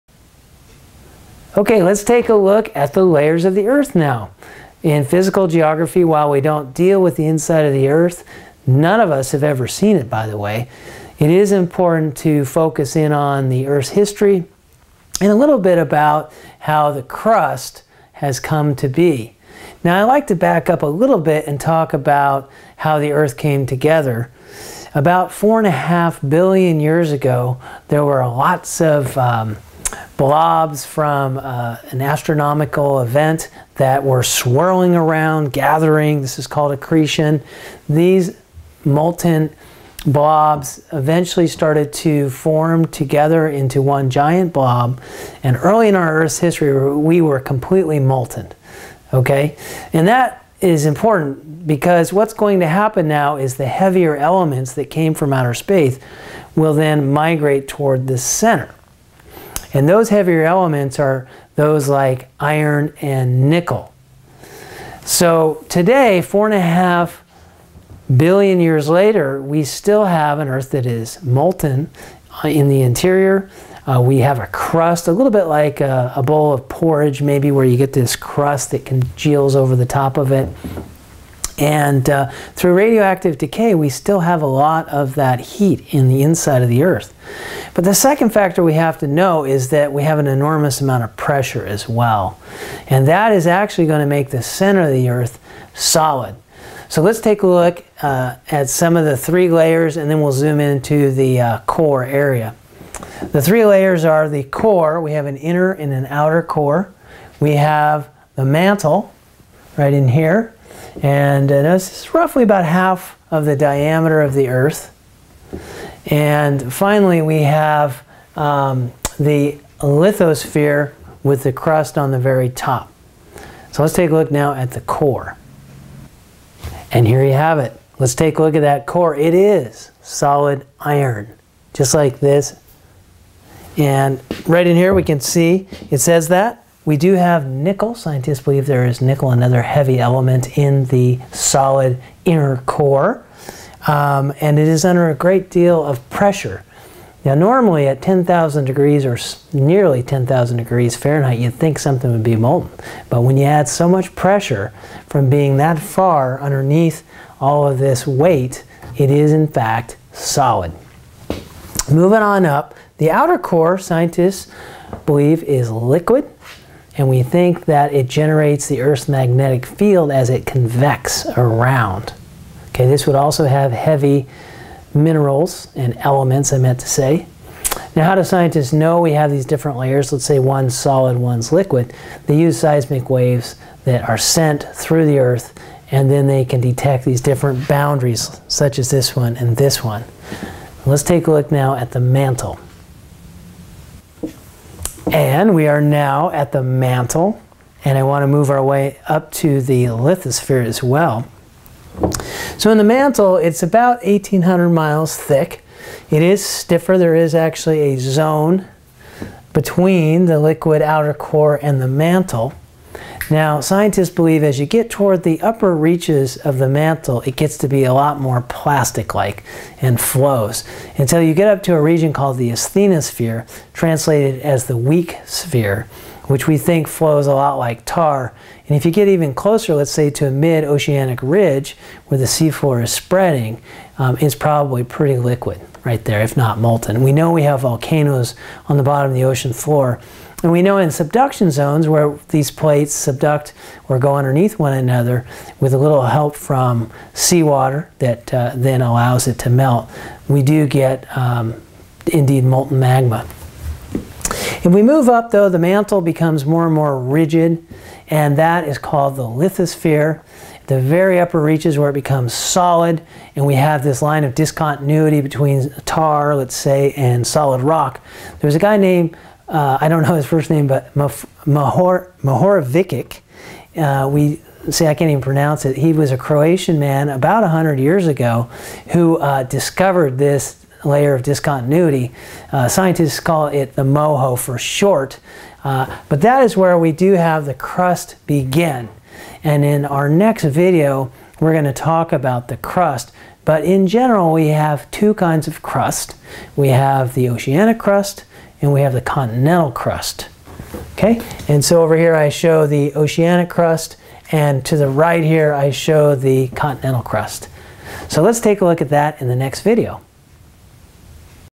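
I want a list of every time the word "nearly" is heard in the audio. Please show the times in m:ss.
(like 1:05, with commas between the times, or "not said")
2:29.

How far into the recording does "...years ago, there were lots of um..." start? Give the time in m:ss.
0:26.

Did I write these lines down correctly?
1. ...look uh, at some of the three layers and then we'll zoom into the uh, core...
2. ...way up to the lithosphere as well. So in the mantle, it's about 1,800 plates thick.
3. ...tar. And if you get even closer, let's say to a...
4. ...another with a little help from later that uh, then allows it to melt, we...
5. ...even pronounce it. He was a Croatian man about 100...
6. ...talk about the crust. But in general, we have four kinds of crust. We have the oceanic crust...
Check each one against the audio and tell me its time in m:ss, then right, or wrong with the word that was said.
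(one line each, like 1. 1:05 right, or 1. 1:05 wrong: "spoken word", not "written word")
1. 1:37 right
2. 3:18 wrong: "miles", not "plates"
3. 3:47 right
4. 4:04 wrong: "seawater", not "later"
5. 4:35 right
6. 4:51 wrong: "two", not "four".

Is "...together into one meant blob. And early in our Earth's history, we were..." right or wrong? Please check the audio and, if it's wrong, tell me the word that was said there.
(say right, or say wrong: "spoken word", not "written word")
wrong: "giant", not "meant".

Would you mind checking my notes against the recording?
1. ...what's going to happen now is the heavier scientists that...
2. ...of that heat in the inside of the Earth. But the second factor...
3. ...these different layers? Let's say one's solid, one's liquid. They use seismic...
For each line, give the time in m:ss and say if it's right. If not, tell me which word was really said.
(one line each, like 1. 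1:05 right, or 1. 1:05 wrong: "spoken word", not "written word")
1. 0:52 wrong: "elements", not "scientists"
2. 1:24 right
3. 2:59 right.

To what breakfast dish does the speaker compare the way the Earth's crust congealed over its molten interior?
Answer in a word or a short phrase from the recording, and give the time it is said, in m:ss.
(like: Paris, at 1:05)
A bowl of porridge, at 1:16.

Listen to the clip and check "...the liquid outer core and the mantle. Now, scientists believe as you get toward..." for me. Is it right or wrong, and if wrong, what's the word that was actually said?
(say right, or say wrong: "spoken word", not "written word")
right.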